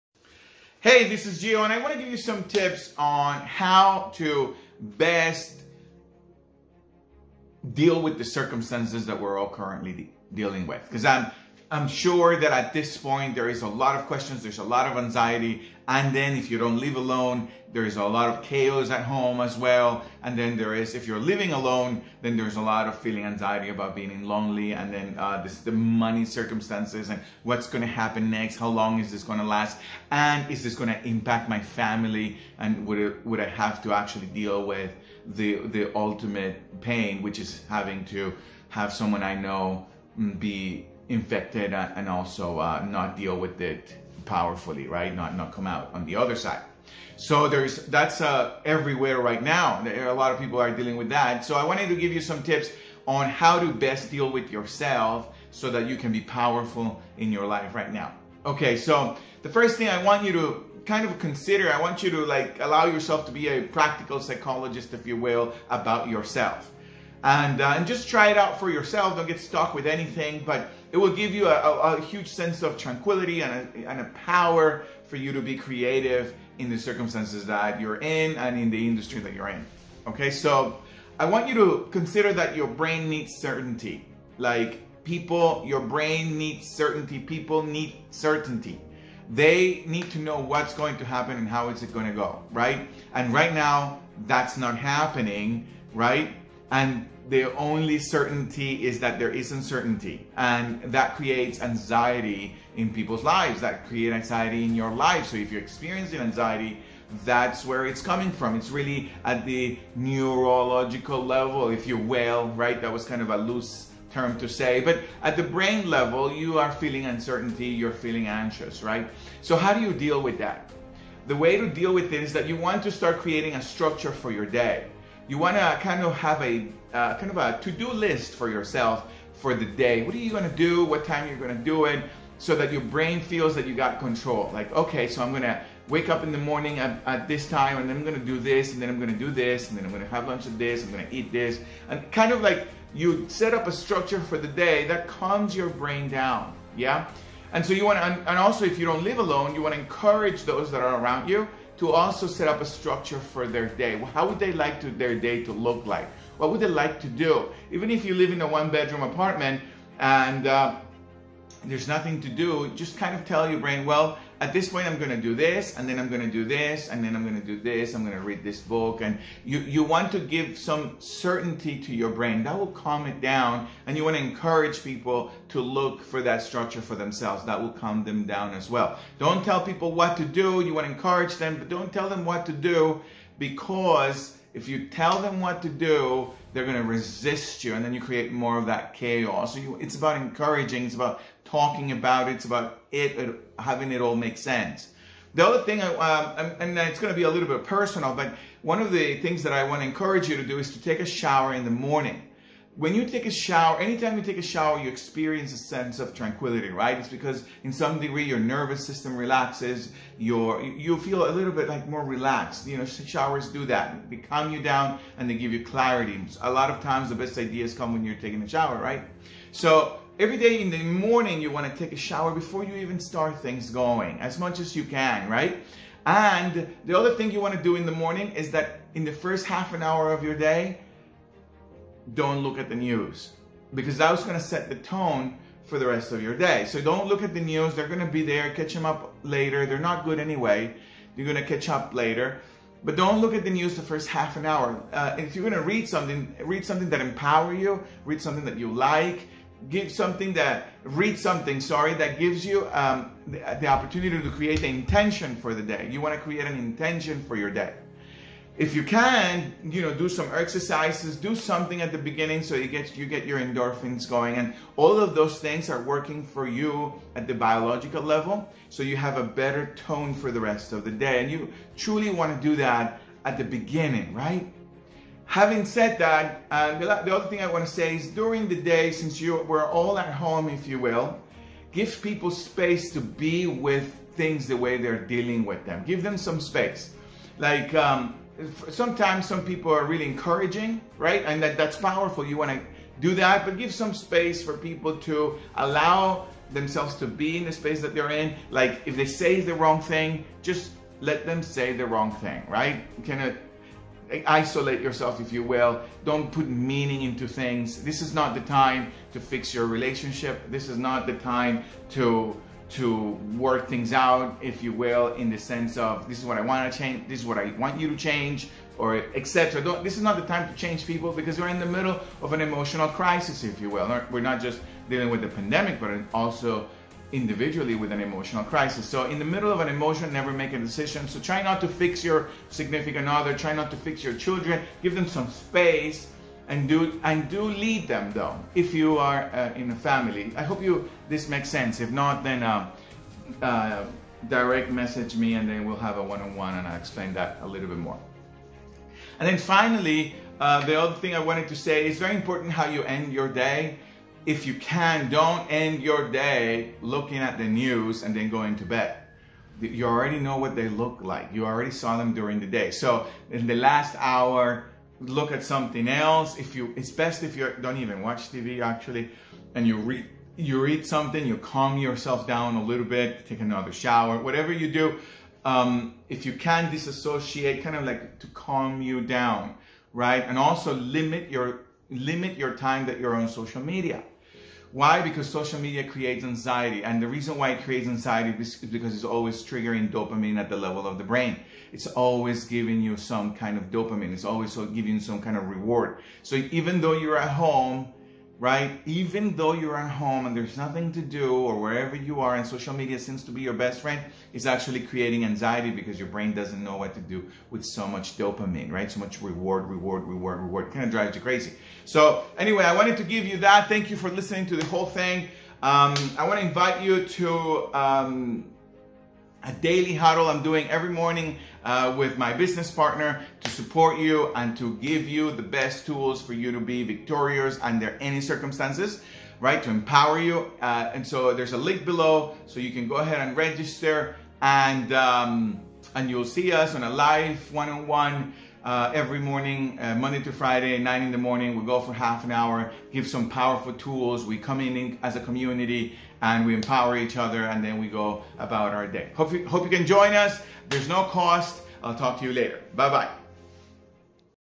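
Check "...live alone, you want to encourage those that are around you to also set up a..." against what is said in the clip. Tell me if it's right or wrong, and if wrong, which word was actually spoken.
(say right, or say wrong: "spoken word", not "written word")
right.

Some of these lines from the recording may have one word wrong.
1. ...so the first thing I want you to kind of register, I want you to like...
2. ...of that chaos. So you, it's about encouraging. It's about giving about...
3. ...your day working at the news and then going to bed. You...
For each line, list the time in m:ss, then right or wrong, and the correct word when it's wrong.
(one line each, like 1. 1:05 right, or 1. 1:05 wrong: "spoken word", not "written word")
1. 0:58 wrong: "consider", not "register"
2. 3:08 wrong: "talking", not "giving"
3. 5:55 wrong: "looking", not "working".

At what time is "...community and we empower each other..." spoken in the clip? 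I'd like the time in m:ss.
7:25.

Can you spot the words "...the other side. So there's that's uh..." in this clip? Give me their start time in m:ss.
0:46.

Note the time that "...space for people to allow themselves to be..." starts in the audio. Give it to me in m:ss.
4:53.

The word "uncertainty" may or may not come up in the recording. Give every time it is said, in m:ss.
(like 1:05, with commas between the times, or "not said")
1:39, 1:57.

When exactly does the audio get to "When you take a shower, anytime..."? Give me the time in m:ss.
3:22.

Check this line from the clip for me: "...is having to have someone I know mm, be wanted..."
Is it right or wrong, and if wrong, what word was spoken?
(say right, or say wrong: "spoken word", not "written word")
wrong: "infected", not "wanted".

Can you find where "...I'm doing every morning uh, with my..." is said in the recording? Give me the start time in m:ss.
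7:00.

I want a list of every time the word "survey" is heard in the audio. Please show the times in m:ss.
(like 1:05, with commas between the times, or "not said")
not said.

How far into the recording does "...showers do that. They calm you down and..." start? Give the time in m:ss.
3:32.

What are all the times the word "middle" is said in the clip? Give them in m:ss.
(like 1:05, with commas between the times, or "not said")
5:21, 5:29.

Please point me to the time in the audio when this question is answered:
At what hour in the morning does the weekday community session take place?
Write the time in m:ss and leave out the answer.
7:20.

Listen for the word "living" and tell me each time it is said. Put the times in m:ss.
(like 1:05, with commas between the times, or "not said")
0:21.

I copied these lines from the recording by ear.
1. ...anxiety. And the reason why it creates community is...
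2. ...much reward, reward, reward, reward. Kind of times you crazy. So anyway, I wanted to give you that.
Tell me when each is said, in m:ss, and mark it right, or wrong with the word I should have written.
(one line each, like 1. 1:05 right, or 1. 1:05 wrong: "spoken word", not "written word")
1. 6:26 wrong: "anxiety", not "community"
2. 6:48 wrong: "drives", not "times".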